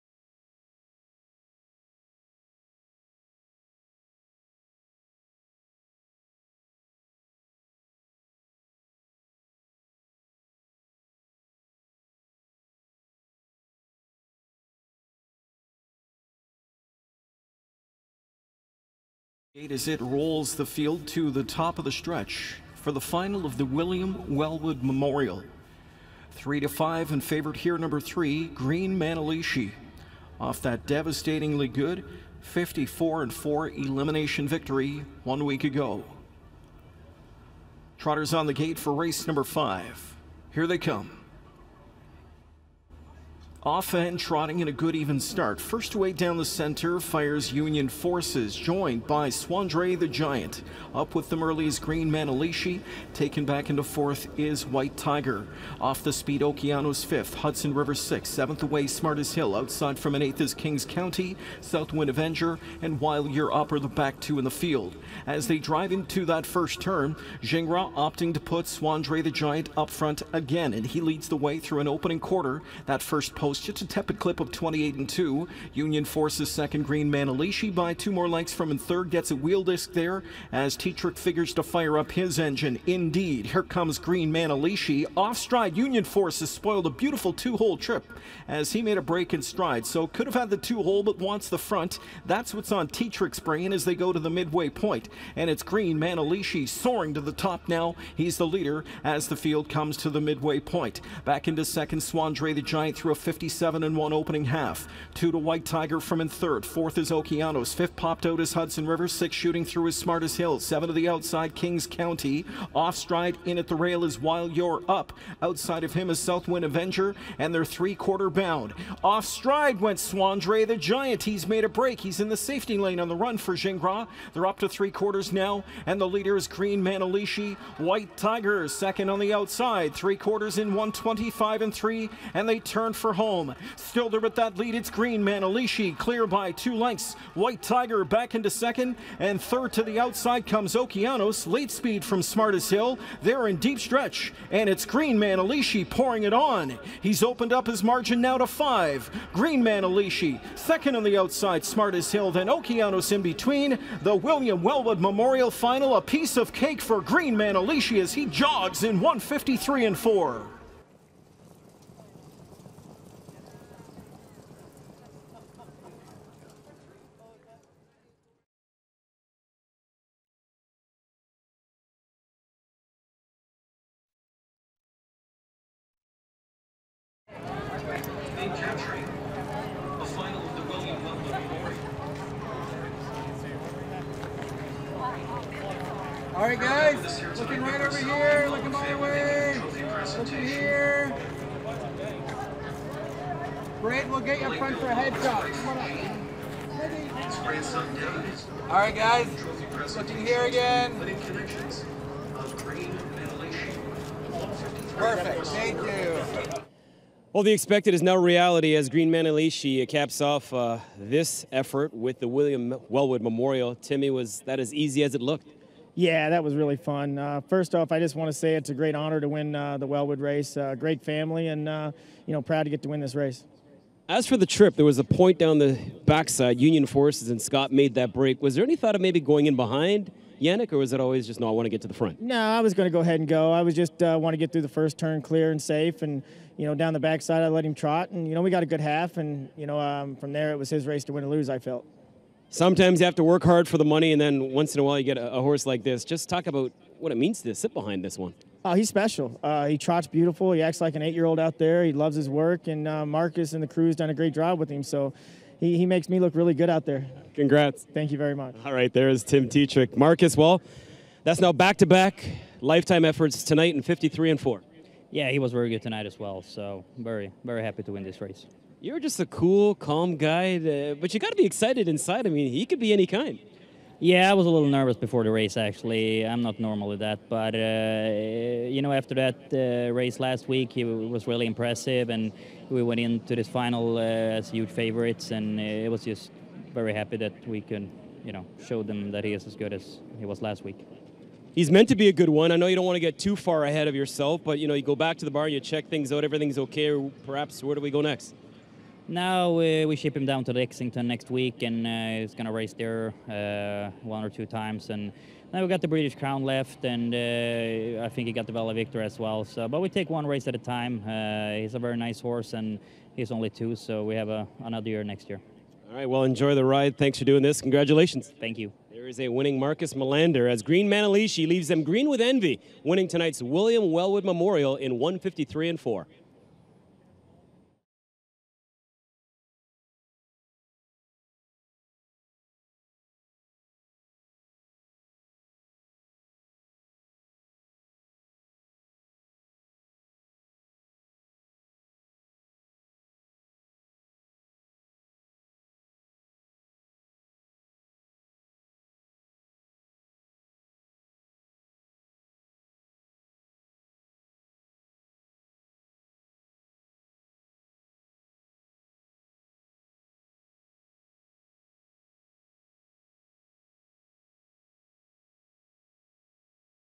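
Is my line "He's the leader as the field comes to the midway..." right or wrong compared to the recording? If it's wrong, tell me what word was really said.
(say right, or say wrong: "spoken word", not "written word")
right.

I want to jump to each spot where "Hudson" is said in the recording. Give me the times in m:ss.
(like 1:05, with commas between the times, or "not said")
0:57, 1:48.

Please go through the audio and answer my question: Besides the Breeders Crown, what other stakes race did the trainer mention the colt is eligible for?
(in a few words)
Valley Victory.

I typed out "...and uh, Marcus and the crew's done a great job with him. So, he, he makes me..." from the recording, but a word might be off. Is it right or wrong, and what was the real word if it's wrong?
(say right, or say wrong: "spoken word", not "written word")
right.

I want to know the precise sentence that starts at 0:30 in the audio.
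Off that devastatingly good 54 and 4 elimination victory one week ago.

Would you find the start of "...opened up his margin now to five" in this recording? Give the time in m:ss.
2:27.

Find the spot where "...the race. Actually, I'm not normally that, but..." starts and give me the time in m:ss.
4:35.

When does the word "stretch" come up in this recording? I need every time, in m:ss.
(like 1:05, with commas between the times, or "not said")
0:21, 2:23.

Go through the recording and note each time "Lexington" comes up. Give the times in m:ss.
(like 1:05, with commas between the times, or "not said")
5:00.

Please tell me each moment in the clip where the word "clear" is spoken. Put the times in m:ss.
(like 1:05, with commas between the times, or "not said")
2:15, 3:55.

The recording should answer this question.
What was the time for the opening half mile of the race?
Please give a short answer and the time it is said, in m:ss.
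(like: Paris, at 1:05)
57.1, at 1:43.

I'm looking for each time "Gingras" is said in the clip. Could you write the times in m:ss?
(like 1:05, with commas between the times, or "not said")
1:07, 2:03.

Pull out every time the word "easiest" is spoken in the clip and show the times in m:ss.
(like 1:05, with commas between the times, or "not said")
not said.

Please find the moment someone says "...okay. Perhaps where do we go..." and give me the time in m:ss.
4:56.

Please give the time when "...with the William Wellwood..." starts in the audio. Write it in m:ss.
3:31.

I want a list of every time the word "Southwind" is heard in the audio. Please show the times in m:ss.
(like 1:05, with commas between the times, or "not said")
1:01, 1:56.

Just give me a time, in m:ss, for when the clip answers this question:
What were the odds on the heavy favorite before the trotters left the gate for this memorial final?
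0:26.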